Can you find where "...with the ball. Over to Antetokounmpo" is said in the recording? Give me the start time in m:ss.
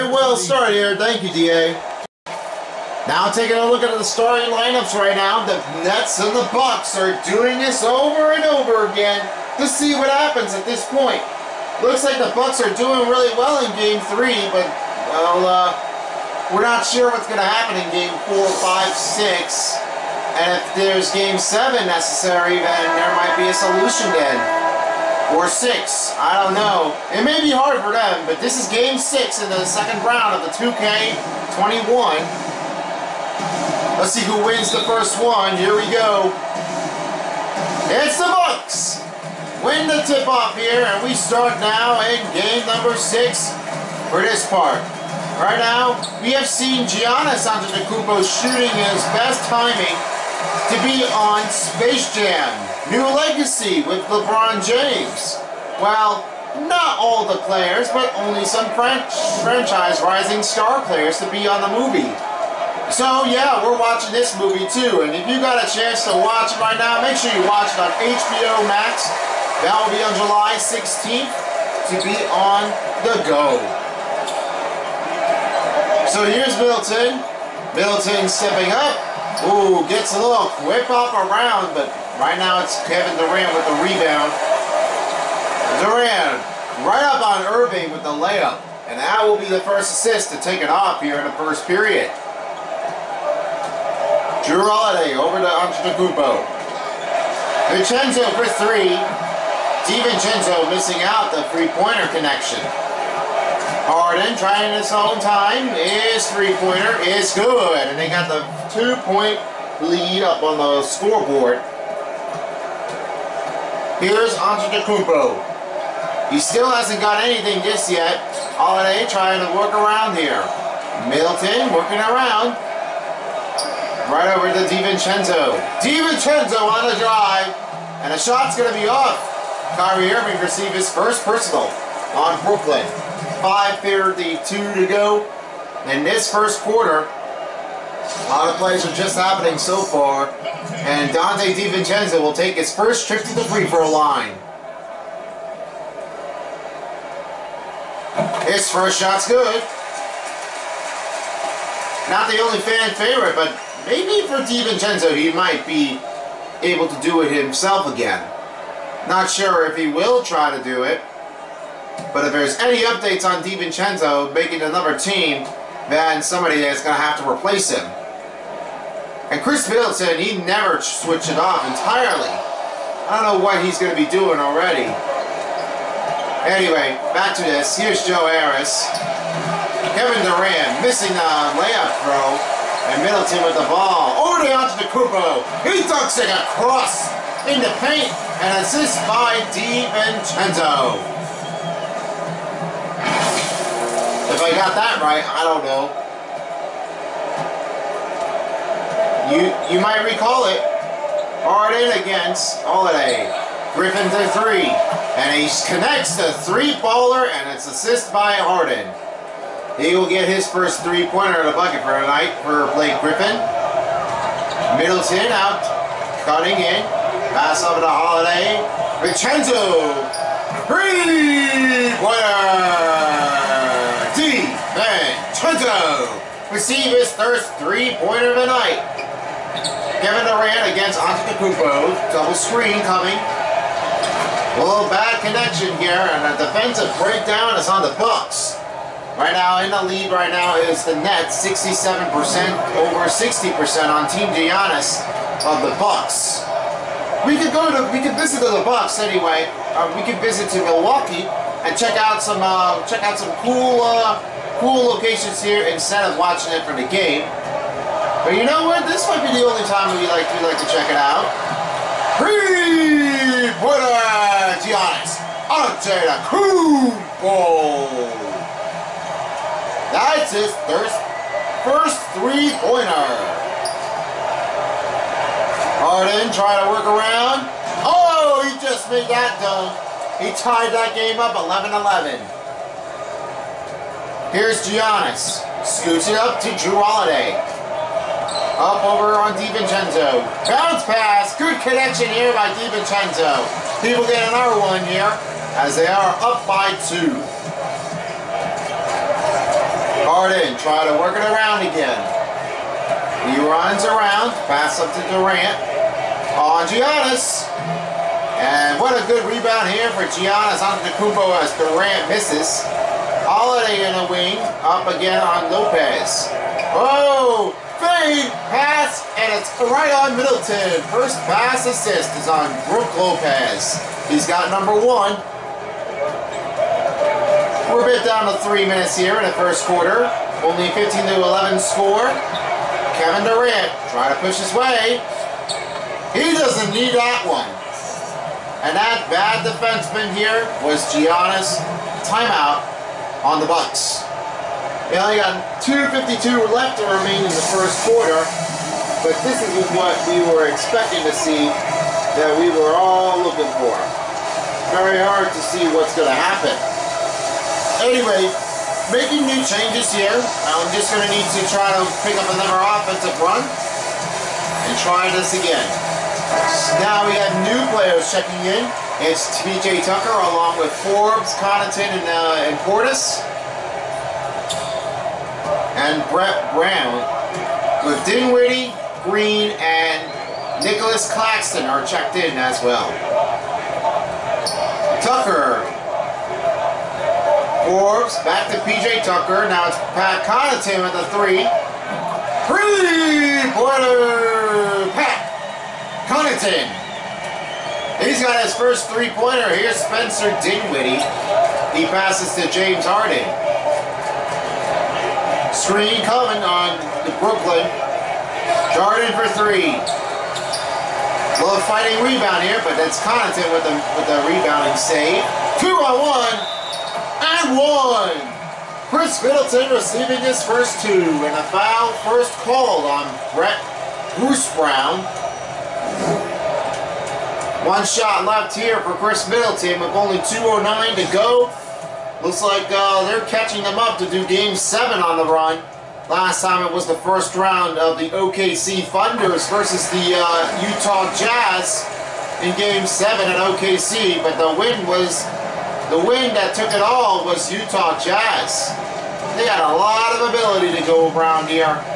3:03.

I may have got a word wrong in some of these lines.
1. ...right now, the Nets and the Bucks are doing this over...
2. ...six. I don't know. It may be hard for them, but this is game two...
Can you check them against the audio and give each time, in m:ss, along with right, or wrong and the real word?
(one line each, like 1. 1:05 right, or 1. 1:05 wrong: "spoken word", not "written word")
1. 0:04 right
2. 0:25 wrong: "six", not "two".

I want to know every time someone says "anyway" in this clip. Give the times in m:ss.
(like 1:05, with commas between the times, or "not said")
2:56, 4:08, 5:57.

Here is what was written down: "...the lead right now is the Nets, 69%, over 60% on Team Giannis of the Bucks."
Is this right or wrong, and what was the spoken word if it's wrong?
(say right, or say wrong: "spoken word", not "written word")
wrong: "67", not "69".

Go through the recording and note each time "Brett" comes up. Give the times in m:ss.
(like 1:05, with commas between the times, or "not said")
6:16, 7:03.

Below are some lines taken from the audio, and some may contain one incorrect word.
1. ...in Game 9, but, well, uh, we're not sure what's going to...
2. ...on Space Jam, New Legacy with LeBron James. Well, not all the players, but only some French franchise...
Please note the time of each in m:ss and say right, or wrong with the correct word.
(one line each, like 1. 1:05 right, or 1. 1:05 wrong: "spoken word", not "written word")
1. 0:13 wrong: "3", not "9"
2. 0:51 right.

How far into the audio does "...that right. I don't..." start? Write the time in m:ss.
3:14.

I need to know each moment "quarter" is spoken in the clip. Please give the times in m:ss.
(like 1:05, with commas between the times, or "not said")
2:16, 5:29, 5:47.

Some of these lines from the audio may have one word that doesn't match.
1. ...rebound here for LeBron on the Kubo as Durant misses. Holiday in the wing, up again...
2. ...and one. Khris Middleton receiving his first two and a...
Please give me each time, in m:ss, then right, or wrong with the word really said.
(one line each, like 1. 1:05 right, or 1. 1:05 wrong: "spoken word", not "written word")
1. 5:09 wrong: "Giannis", not "LeBron"
2. 6:57 right.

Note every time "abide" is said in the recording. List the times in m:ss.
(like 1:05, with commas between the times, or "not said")
not said.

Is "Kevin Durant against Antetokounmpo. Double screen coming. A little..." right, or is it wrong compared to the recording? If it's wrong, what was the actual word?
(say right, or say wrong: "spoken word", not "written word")
right.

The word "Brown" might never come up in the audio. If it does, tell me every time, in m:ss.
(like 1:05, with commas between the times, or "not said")
6:16, 7:04.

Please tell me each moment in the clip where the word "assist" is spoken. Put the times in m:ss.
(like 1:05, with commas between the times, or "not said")
1:29, 3:08, 3:27, 5:21.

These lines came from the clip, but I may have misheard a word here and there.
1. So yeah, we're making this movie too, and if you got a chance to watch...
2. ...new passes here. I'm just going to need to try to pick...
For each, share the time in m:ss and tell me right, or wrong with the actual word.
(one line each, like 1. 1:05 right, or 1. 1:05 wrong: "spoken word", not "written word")
1. 1:02 wrong: "watching", not "making"
2. 5:59 wrong: "changes", not "passes".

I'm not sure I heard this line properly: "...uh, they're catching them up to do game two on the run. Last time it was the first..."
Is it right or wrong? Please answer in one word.
wrong.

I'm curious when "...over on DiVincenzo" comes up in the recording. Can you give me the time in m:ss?
4:48.